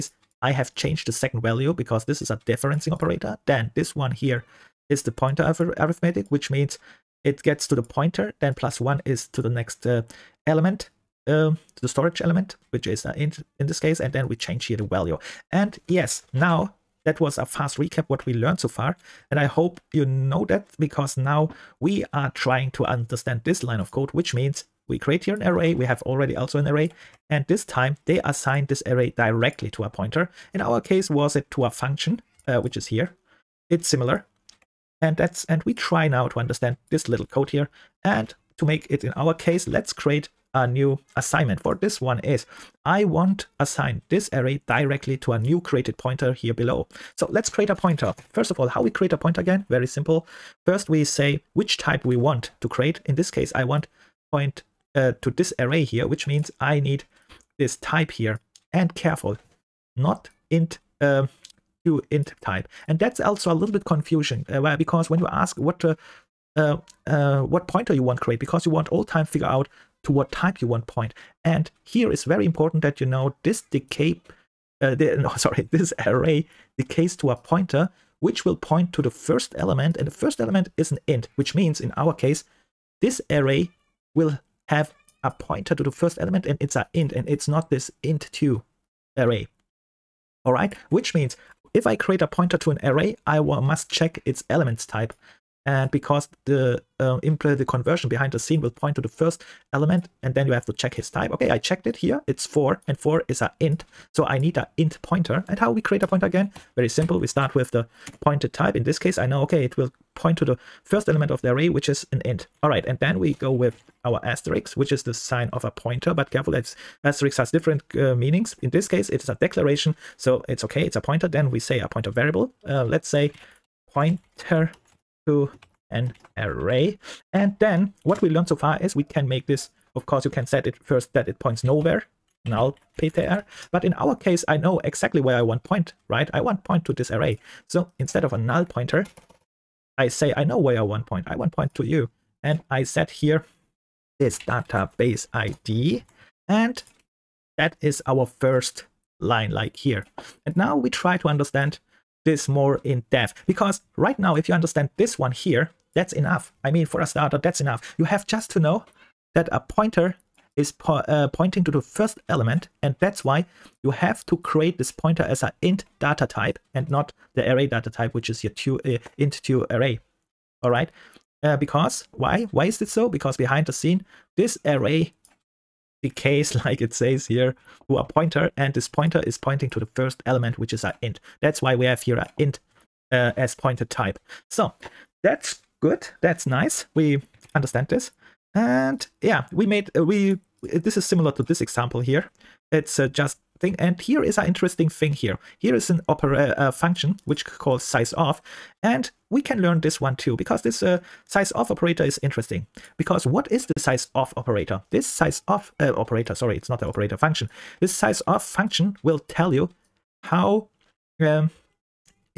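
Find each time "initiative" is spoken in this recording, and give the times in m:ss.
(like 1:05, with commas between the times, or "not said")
not said.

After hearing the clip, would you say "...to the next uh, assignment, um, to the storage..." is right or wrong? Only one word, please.
wrong.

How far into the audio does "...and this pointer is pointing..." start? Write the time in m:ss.
2:58.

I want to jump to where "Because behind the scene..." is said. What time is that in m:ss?
2:53.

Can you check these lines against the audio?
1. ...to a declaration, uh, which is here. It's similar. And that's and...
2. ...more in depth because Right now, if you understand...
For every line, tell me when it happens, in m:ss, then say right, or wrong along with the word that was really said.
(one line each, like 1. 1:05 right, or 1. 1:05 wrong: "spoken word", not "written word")
1. 0:31 wrong: "function", not "declaration"
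2. 2:32 right.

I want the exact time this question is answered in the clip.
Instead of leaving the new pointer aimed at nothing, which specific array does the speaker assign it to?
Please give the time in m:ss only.
2:24.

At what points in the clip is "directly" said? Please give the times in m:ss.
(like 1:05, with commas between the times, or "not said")
0:29, 0:44.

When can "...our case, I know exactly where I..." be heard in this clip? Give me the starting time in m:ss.
2:13.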